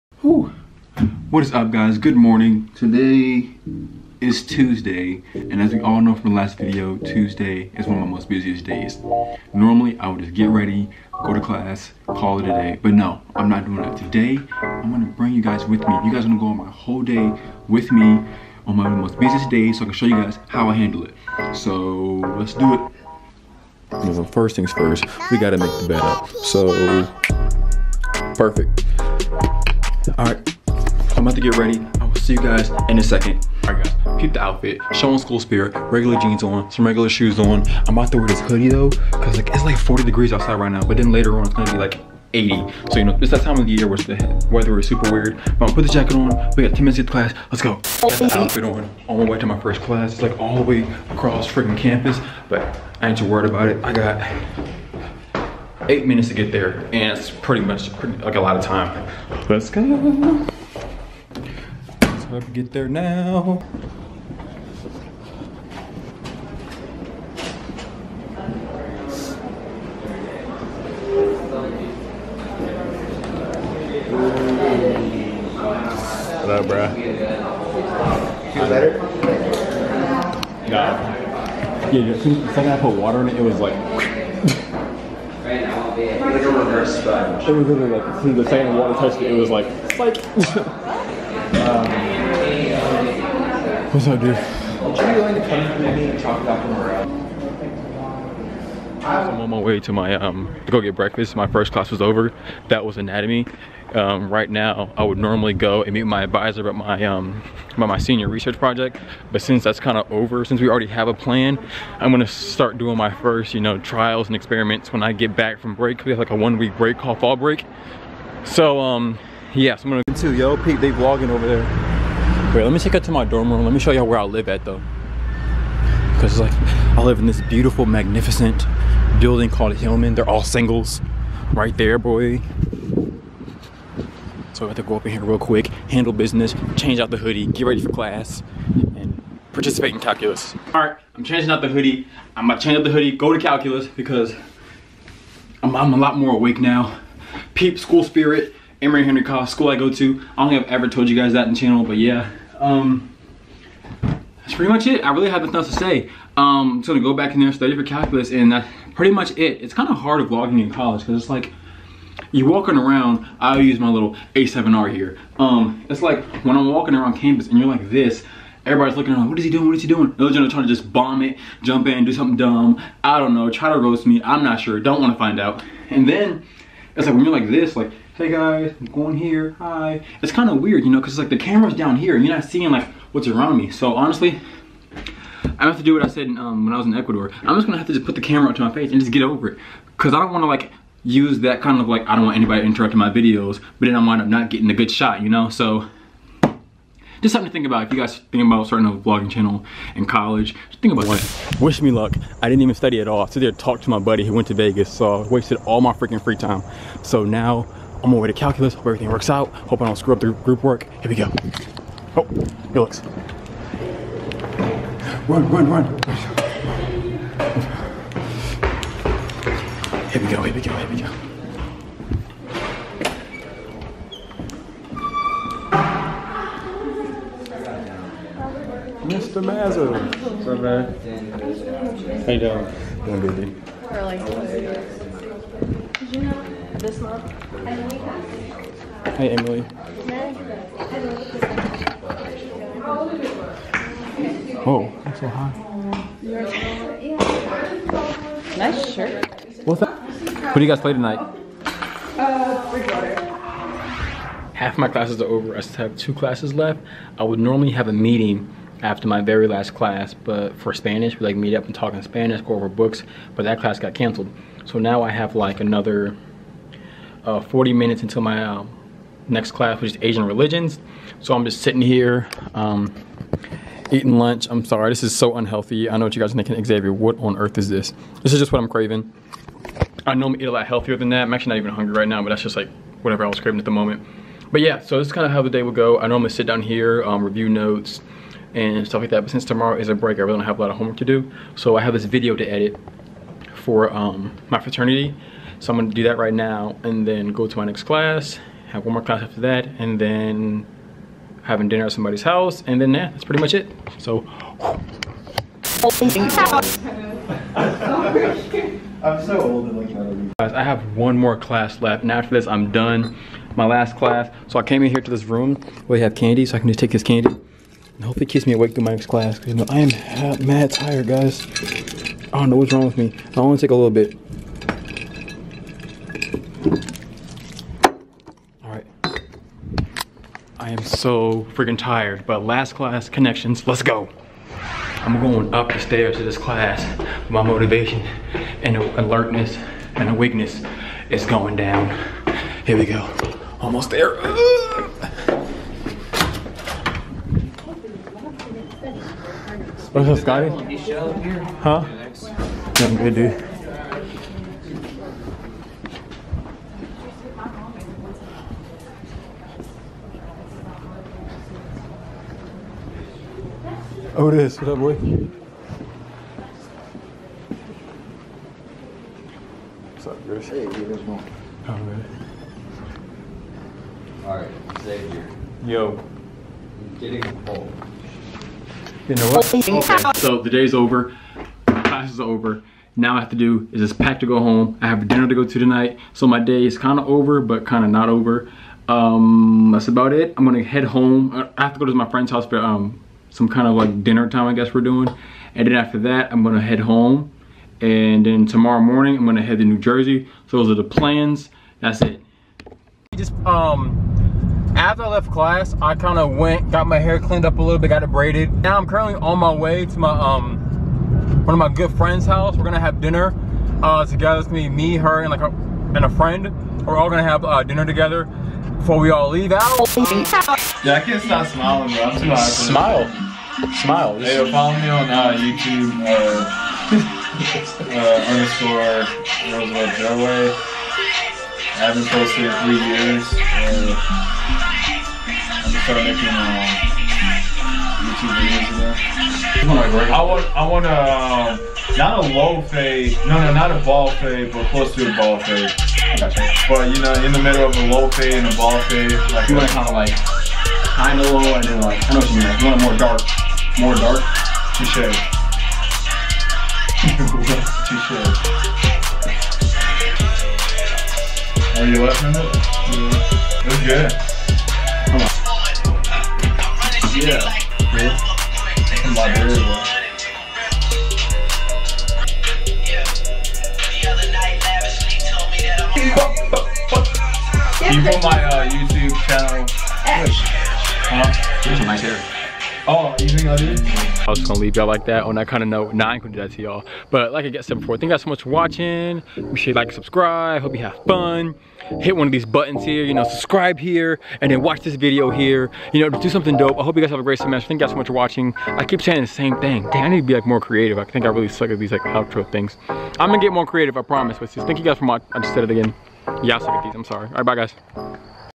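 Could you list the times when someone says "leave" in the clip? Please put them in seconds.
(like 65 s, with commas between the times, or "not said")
419 s, 484 s.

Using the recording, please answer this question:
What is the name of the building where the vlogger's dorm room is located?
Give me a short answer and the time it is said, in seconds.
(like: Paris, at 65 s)
Hillman, at 129 s.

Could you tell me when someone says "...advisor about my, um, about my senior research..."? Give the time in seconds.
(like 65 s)
106 s.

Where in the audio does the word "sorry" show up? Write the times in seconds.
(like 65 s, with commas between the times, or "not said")
274 s, 507 s.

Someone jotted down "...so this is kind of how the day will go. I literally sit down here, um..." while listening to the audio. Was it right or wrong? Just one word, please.
wrong.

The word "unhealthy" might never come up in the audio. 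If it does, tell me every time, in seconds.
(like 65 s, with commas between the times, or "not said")
275 s.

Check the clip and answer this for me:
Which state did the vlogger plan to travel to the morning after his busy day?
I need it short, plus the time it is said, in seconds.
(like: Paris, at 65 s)
New Jersey, at 399 s.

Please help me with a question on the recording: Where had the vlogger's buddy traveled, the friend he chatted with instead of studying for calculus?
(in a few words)
Vegas.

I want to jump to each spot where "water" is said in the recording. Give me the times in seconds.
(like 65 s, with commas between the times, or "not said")
82 s, 88 s.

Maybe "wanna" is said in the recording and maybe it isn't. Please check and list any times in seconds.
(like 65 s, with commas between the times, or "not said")
175 s, 190 s.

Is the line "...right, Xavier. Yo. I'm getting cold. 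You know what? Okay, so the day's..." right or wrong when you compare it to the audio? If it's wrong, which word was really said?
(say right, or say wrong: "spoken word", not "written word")
right.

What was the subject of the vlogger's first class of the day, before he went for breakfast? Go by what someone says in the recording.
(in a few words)
Anatomy.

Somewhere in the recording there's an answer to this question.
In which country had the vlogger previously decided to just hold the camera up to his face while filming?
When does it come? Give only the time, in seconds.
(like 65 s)
186 s.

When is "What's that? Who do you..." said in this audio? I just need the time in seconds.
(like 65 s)
249 s.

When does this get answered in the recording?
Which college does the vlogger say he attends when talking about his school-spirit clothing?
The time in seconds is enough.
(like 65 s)
148 s.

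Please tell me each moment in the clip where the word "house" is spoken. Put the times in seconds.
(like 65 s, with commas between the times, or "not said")
302 s, 392 s, 412 s.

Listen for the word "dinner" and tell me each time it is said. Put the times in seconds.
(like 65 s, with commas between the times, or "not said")
301 s, 385 s, 394 s, 413 s, 417 s.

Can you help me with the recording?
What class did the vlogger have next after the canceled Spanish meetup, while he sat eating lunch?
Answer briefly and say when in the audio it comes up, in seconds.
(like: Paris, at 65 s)
Asian religions, at 270 s.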